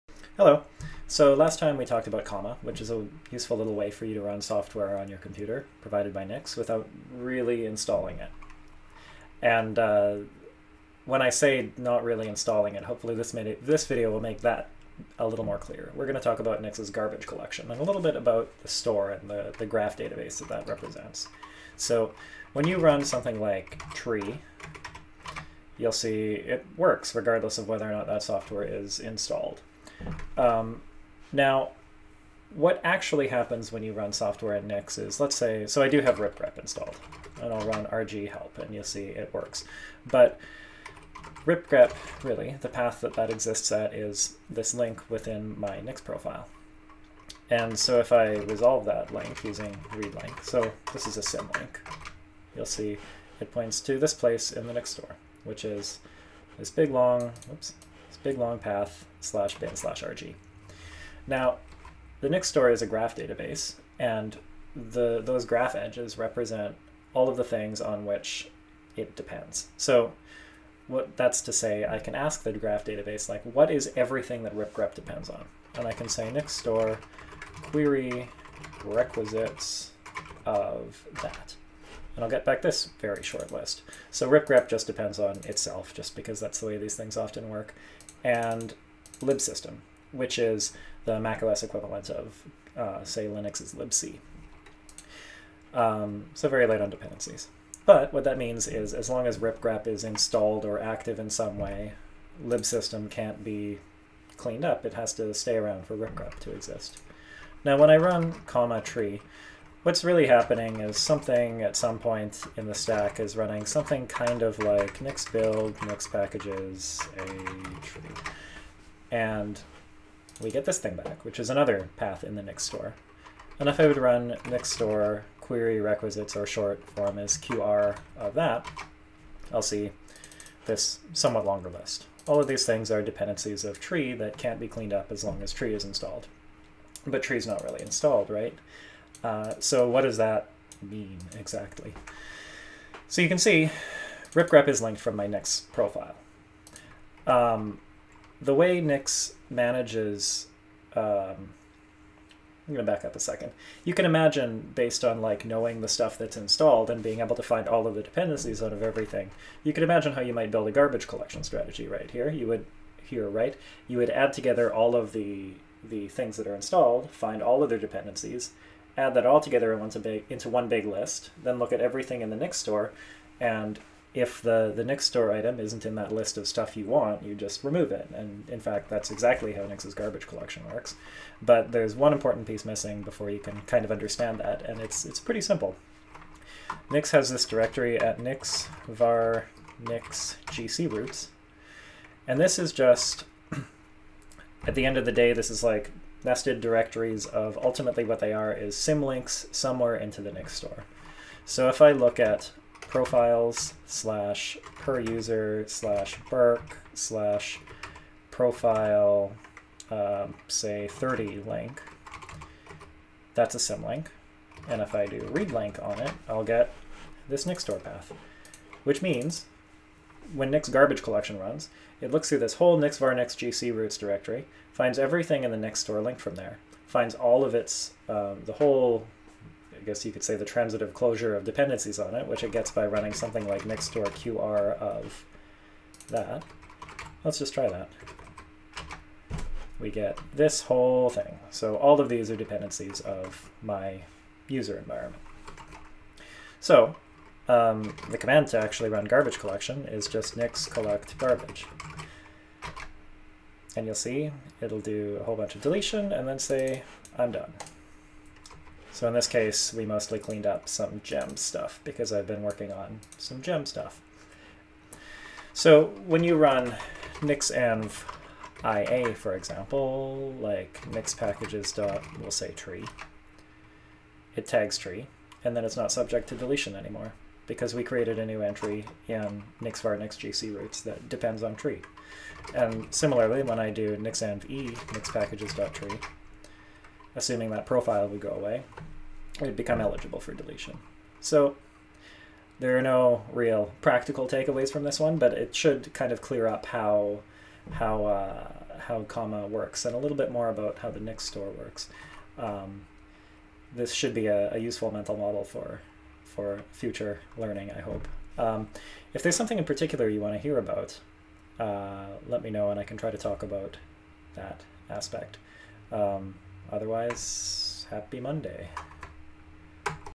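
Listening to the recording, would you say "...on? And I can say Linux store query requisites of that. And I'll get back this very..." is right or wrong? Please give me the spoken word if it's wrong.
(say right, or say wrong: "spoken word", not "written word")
wrong: "Nix", not "Linux".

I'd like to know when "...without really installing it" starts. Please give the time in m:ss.
0:06.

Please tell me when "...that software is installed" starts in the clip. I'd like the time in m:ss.
0:28.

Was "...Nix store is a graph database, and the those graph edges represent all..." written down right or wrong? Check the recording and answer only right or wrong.
right.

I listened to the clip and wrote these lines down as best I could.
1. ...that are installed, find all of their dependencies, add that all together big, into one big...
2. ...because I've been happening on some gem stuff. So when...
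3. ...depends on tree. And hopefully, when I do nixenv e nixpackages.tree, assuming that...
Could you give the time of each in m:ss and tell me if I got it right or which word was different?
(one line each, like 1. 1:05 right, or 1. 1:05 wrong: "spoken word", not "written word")
1. 2:46 right
2. 4:21 wrong: "working", not "happening"
3. 4:41 wrong: "similarly", not "hopefully".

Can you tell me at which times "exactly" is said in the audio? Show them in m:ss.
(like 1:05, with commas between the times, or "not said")
2:21, 2:59.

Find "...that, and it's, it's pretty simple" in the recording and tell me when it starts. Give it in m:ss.
3:04.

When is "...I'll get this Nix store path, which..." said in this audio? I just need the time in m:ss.
3:36.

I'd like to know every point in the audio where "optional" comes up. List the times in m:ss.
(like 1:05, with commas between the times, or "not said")
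not said.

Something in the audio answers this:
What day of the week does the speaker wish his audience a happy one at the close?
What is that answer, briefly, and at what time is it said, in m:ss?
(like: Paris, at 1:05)
Monday, at 5:18.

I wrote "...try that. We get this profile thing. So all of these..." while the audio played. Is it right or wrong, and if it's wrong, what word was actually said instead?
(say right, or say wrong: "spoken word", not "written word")
wrong: "whole", not "profile".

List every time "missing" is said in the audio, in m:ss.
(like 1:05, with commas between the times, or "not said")
3:02.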